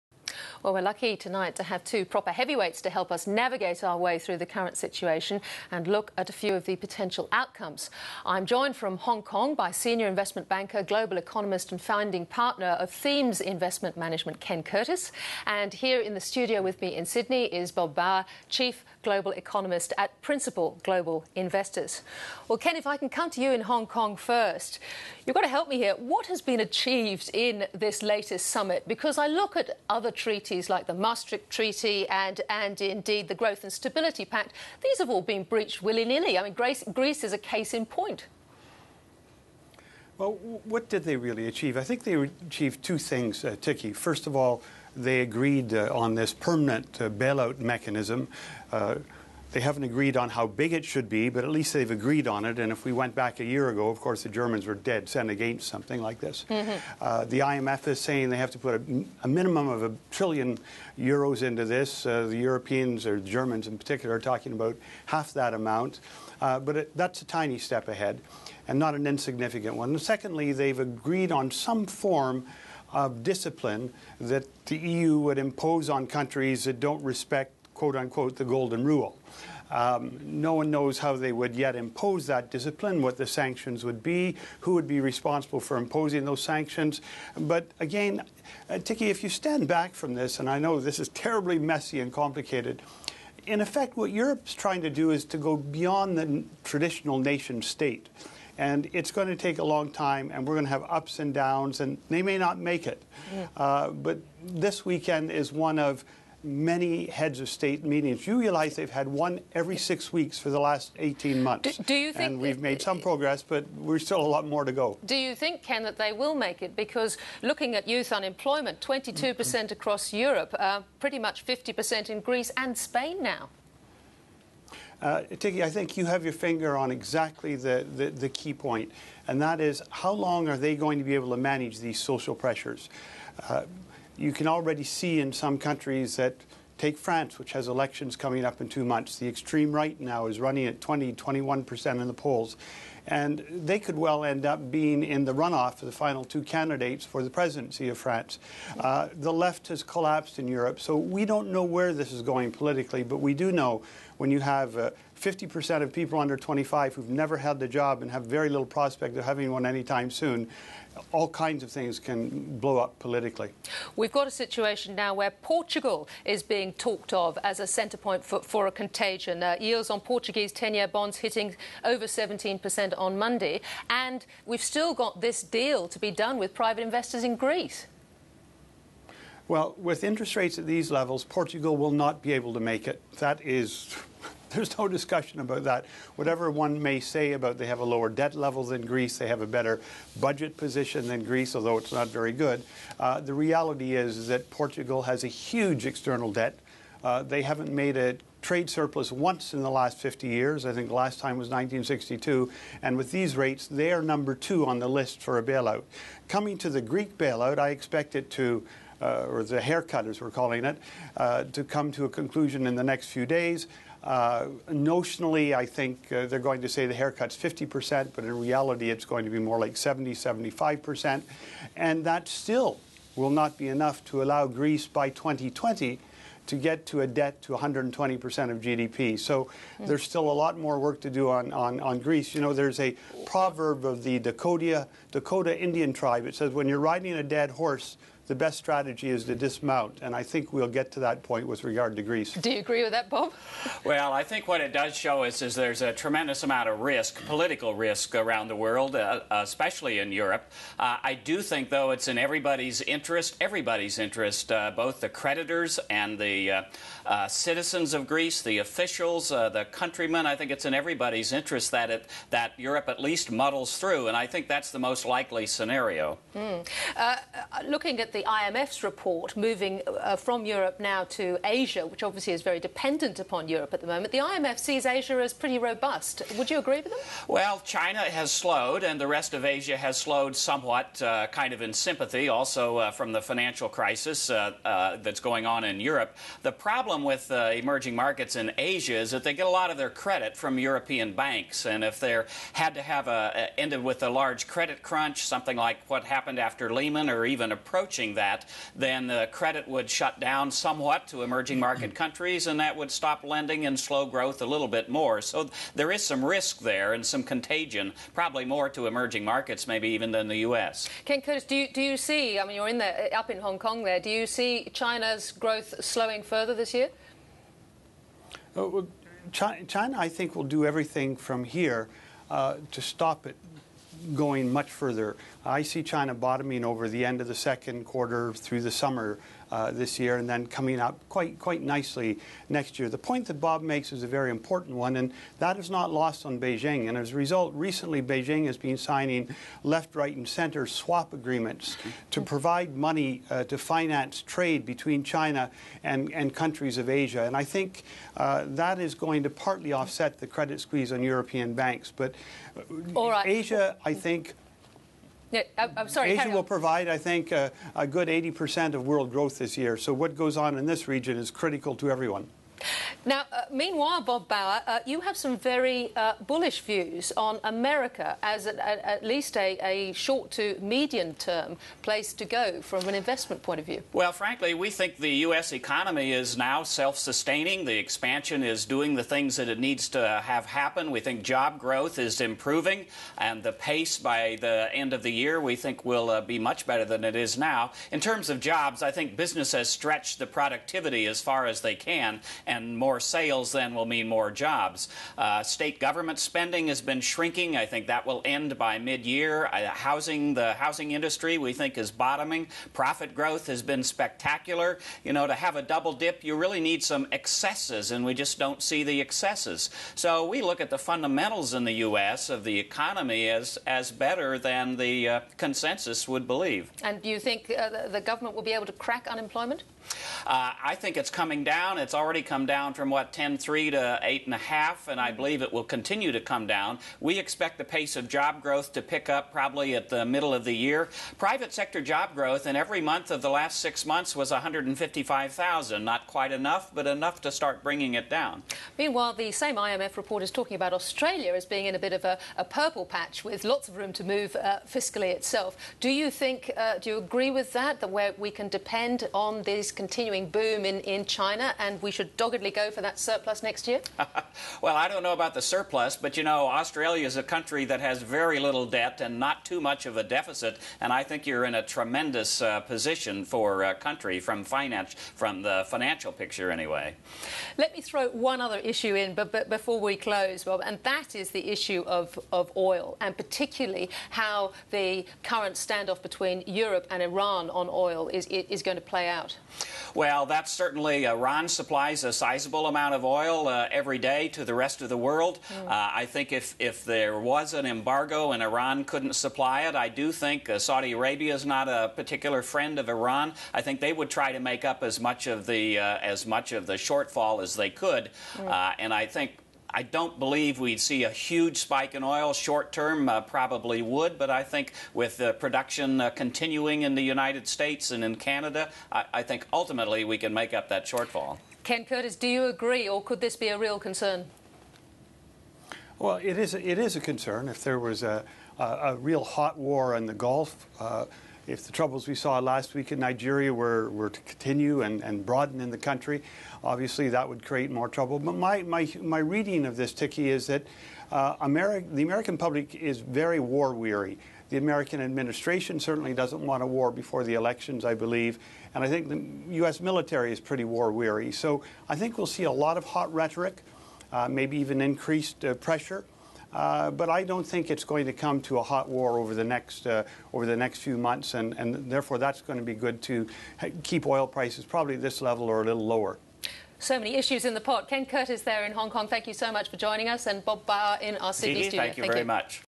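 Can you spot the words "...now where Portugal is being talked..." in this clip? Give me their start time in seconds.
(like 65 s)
164 s.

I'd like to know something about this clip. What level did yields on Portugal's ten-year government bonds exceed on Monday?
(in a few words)
17%.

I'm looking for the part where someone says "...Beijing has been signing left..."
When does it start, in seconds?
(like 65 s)
338 s.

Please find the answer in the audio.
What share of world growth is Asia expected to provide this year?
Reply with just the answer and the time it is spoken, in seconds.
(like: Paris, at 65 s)
80%, at 358 s.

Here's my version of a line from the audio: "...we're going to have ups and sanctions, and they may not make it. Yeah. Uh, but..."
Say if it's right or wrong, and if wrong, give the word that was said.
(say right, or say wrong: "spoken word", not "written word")
wrong: "downs", not "sanctions".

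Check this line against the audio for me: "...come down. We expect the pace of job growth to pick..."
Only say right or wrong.
right.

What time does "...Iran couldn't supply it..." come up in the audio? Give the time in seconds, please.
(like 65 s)
488 s.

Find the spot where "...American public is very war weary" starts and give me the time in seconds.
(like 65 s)
532 s.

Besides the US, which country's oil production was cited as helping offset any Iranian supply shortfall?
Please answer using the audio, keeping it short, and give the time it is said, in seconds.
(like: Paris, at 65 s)
Canada, at 508 s.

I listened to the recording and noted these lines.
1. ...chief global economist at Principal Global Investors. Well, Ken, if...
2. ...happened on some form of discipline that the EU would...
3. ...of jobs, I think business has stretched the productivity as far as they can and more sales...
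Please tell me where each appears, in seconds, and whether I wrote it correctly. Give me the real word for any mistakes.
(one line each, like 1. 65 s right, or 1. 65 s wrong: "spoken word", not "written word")
1. 18 s right
2. 70 s wrong: "agreed", not "happened"
3. 388 s right.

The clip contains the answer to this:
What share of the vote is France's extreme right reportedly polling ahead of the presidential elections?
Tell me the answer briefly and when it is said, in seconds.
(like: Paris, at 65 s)
20-21%, at 140 s.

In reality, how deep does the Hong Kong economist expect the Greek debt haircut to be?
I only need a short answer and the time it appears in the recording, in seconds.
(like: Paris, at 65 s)
70-75%, at 219 s.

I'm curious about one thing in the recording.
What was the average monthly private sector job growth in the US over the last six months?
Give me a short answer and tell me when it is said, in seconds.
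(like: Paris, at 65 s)
155,000, at 434 s.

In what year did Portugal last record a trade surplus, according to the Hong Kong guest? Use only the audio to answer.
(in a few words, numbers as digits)
1962.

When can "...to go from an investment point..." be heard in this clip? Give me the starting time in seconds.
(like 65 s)
372 s.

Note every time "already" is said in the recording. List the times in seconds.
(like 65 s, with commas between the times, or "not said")
134 s, 421 s.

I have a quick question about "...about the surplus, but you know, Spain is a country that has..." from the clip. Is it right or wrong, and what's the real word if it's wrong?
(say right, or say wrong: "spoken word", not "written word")
wrong: "Australia", not "Spain".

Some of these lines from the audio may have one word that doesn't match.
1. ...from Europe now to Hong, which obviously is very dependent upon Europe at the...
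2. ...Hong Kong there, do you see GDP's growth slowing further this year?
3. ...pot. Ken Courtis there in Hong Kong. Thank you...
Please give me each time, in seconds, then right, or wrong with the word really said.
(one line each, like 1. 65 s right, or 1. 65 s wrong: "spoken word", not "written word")
1. 270 s wrong: "Asia", not "Hong"
2. 313 s wrong: "China", not "GDP"
3. 557 s right.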